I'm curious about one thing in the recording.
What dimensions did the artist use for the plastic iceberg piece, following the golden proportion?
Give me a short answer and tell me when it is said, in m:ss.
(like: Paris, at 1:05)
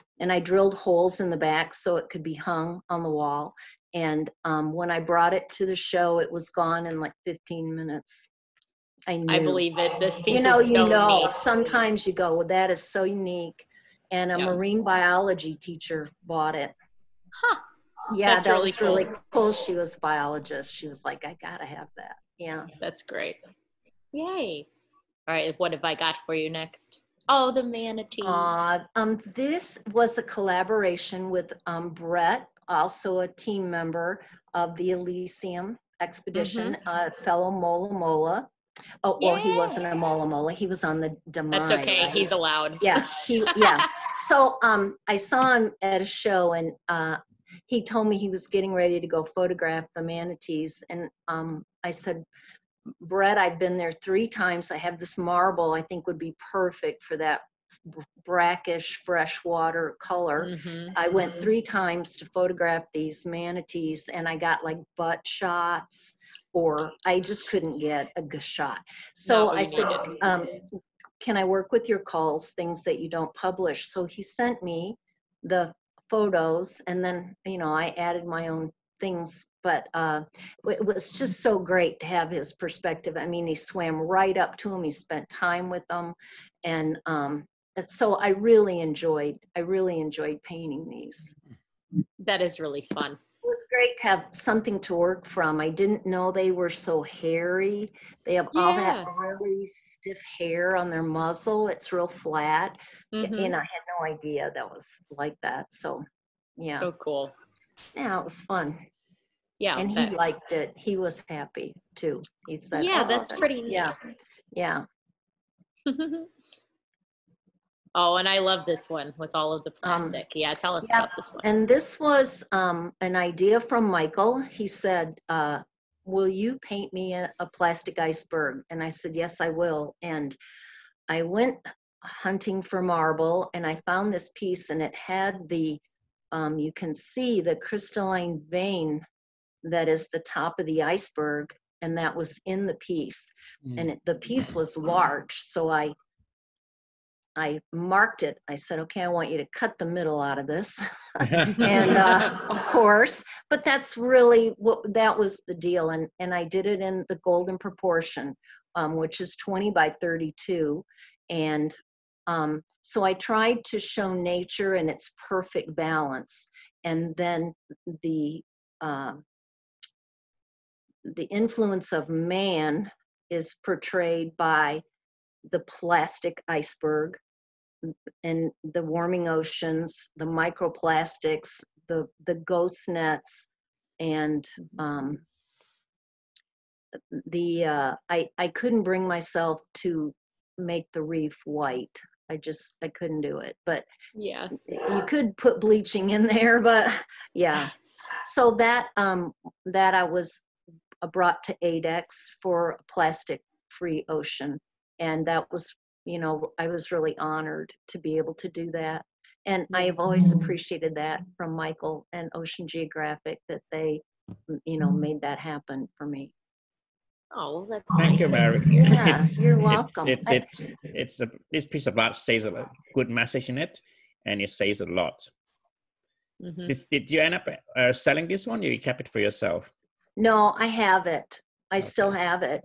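20 by 32, at 2:39.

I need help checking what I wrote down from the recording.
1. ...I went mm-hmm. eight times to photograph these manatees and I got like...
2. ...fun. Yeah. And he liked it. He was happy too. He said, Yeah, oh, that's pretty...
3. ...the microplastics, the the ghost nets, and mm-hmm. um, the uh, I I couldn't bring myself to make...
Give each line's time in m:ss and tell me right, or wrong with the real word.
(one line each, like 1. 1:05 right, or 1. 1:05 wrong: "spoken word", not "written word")
1. 1:00 wrong: "three", not "eight"
2. 1:48 right
3. 3:00 right.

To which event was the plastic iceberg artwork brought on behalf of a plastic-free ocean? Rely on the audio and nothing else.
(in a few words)
ADEX.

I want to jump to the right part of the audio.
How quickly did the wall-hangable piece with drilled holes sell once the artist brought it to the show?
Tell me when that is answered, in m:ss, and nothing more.
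0:07.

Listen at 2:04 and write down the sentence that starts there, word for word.
He said, uh, Will you paint me a, a, plastic iceberg?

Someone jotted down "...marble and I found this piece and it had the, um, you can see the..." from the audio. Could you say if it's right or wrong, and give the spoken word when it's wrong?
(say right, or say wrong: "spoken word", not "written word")
right.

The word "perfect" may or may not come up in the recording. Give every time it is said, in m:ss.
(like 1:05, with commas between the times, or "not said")
0:56, 2:45.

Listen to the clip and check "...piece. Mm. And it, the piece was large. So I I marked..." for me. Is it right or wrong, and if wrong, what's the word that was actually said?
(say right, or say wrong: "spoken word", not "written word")
right.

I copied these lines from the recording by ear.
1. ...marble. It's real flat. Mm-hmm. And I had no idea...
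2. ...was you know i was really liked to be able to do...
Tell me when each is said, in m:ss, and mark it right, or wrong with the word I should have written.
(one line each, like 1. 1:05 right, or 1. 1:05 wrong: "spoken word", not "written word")
1. 1:41 wrong: "muzzle", not "marble"
2. 3:25 wrong: "honored", not "liked".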